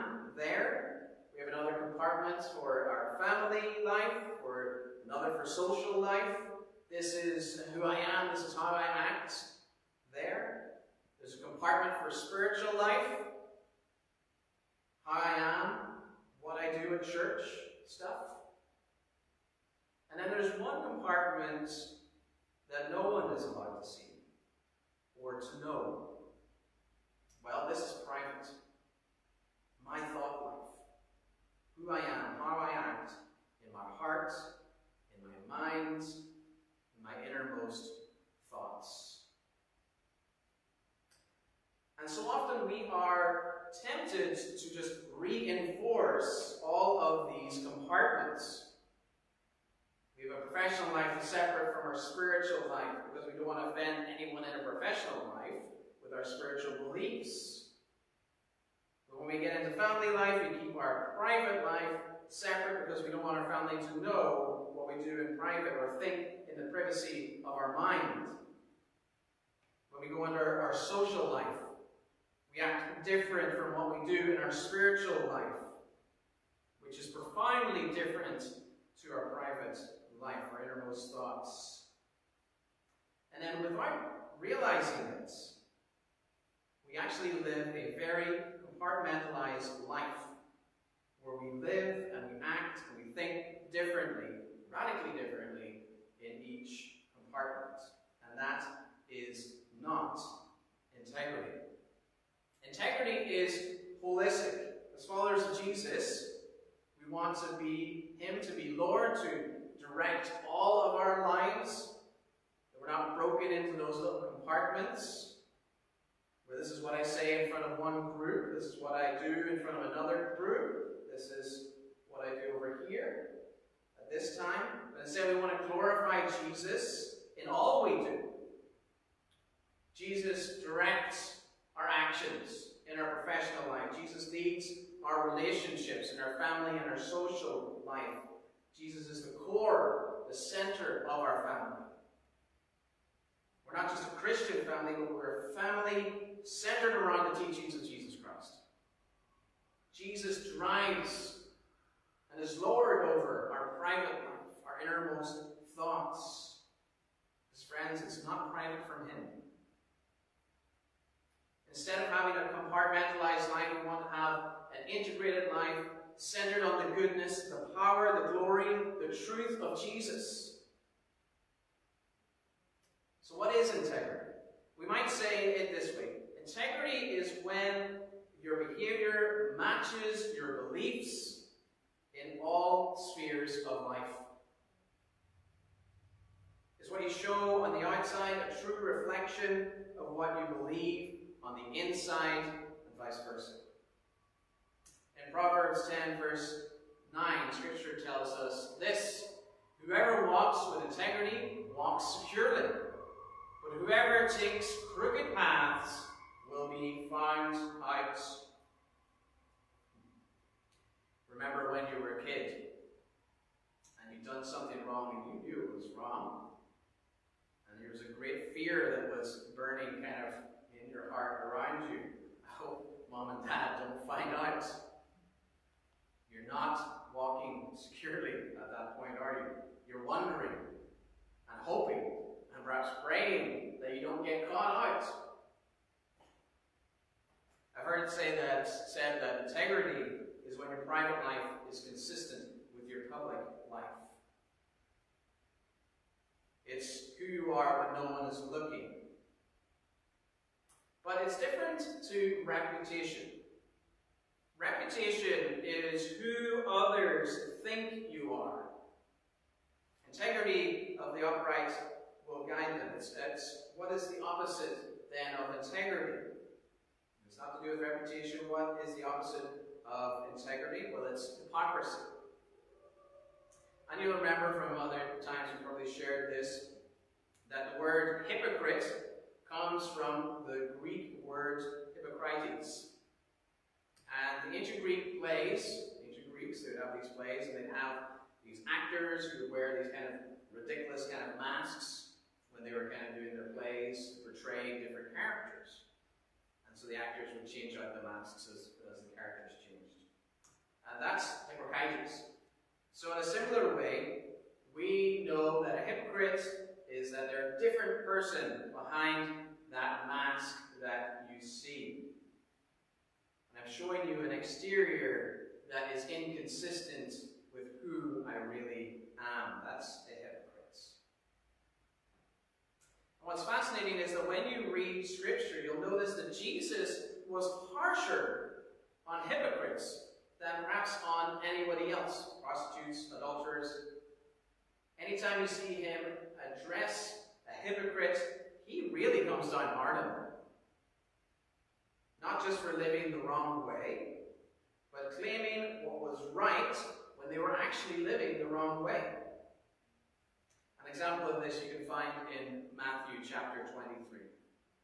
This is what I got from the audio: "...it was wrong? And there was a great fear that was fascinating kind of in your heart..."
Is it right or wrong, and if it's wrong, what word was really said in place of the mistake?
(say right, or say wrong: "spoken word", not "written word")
wrong: "burning", not "fascinating".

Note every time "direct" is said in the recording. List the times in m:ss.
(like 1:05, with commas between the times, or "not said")
1:49, 2:10.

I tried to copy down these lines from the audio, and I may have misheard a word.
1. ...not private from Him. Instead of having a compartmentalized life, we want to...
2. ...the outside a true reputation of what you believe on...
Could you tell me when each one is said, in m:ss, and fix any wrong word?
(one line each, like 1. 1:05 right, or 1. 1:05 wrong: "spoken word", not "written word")
1. 2:38 right
2. 3:07 wrong: "reflection", not "reputation".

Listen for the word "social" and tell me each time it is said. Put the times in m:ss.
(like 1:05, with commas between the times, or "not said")
0:05, 1:10, 2:16.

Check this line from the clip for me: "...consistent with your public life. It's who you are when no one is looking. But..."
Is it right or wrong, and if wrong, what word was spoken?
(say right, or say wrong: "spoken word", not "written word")
right.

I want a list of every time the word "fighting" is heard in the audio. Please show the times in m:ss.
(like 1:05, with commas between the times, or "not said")
not said.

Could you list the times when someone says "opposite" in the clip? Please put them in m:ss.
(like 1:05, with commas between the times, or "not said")
4:24, 4:29.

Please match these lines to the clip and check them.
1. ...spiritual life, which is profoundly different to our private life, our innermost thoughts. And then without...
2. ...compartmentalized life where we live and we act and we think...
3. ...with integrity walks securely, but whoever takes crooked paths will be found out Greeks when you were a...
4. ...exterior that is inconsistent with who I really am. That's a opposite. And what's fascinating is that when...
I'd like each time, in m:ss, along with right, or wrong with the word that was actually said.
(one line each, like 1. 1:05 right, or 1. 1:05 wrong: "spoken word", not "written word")
1. 1:14 right
2. 1:28 right
3. 3:20 wrong: "Remember", not "Greeks"
4. 5:14 wrong: "hypocrite", not "opposite".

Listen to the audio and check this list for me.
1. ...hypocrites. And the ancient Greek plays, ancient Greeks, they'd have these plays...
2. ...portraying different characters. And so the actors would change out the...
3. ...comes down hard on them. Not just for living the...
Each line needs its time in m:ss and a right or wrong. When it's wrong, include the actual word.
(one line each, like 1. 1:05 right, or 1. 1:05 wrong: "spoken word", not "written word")
1. 4:41 right
2. 4:54 right
3. 5:39 right.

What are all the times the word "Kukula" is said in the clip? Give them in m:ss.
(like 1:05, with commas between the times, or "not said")
not said.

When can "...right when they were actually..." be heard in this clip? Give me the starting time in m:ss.
5:46.